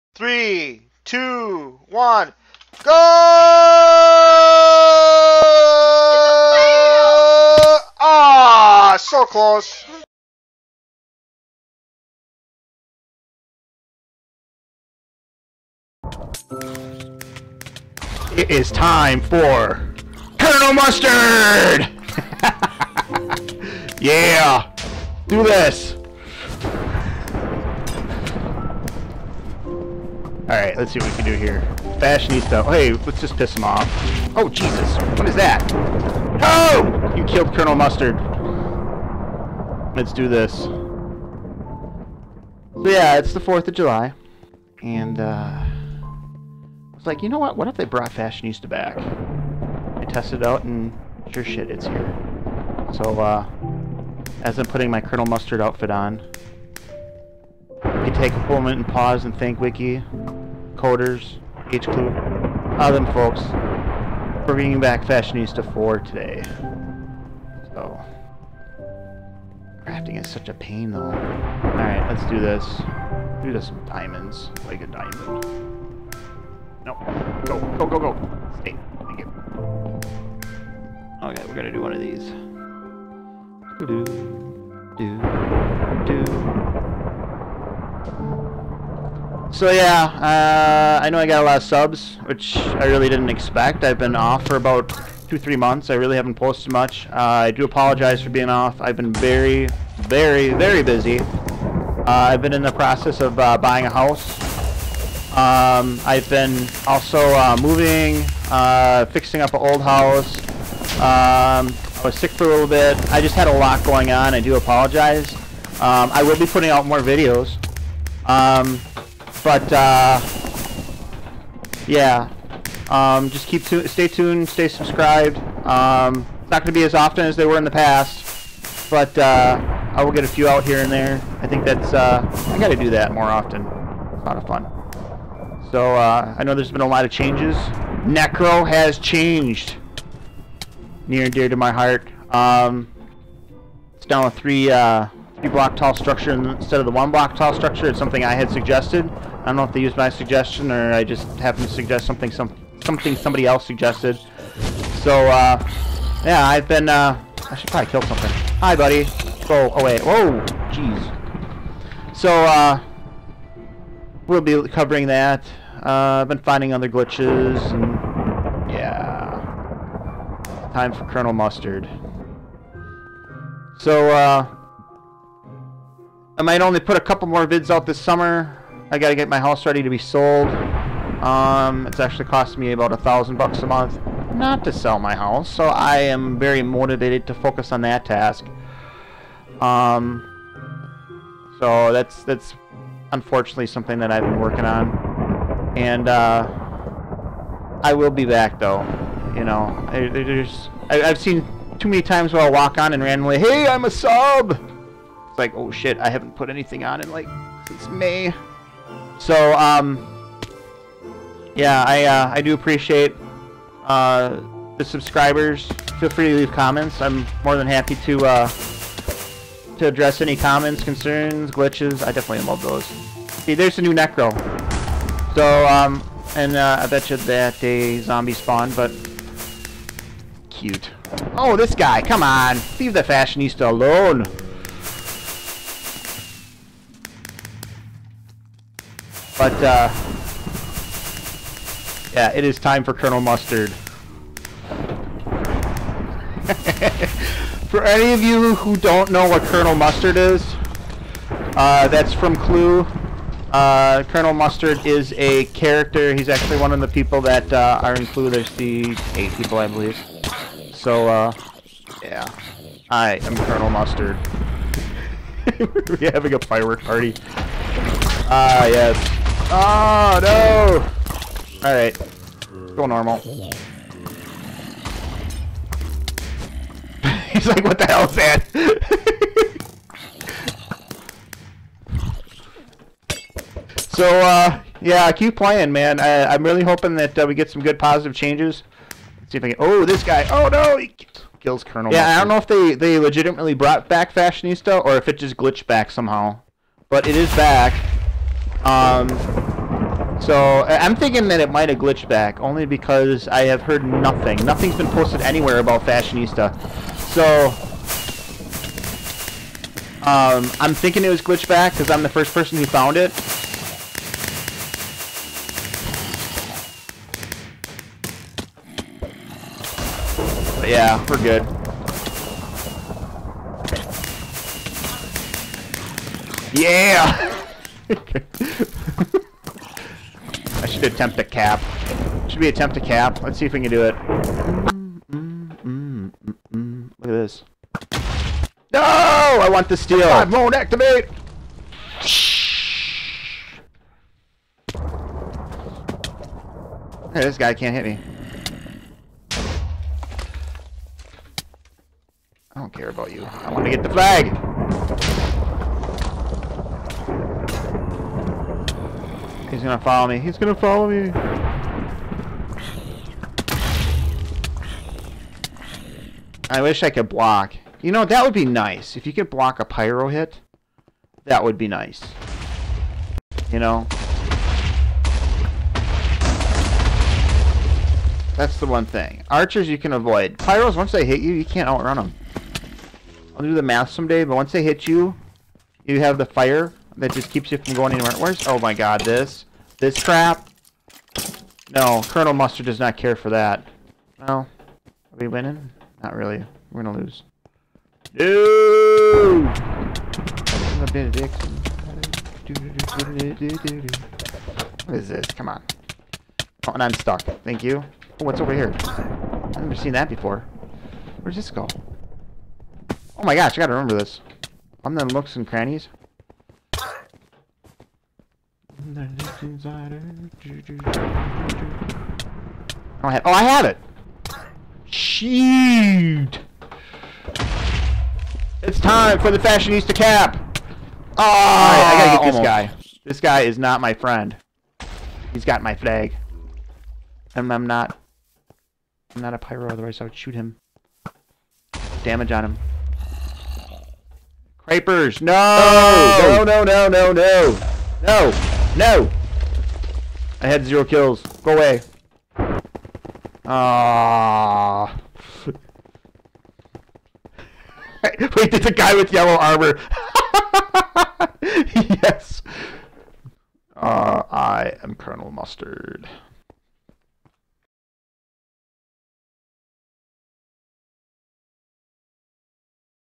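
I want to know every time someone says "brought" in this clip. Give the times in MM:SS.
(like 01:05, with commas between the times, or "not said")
00:47, 04:53.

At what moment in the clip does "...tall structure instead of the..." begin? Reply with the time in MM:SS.
02:25.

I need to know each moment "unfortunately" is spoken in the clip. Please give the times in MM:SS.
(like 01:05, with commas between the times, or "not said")
03:13.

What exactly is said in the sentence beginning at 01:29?
So yeah, uh, I know I got a lot of subs, which I really didn't expect.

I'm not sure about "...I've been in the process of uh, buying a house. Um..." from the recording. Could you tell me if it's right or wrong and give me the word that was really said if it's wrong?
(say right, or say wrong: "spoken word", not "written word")
right.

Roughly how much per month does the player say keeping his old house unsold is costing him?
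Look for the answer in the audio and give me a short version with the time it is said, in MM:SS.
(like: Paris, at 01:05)
$1,000, at 03:02.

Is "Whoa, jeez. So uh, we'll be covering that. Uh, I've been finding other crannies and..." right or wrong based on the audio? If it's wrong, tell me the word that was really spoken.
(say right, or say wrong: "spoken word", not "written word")
wrong: "glitches", not "crannies".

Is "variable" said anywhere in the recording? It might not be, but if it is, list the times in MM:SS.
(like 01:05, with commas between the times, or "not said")
not said.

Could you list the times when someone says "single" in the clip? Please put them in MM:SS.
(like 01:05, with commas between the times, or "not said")
not said.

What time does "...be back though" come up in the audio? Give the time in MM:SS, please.
03:18.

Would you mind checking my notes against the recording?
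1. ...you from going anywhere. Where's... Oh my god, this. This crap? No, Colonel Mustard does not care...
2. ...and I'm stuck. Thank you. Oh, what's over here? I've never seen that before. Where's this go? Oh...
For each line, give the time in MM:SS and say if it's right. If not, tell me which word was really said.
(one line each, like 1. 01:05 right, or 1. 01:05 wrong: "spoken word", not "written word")
1. 06:27 right
2. 06:46 right.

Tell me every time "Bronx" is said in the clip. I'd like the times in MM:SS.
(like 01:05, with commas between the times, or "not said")
not said.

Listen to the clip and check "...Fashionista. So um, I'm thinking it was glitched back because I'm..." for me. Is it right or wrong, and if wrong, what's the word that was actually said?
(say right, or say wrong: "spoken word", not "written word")
right.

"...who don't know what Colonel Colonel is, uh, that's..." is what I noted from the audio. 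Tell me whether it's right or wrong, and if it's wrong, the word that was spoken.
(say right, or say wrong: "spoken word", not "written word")
wrong: "Mustard", not "Colonel".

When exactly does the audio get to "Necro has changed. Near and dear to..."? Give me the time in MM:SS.
02:18.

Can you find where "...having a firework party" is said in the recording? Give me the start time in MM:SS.
04:26.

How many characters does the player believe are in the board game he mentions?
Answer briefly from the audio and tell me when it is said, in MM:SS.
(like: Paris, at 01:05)
8, at 04:19.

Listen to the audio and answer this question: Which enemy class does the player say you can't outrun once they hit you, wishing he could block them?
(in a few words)
Pyros.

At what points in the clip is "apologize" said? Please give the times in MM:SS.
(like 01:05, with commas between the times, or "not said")
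01:37, 01:54.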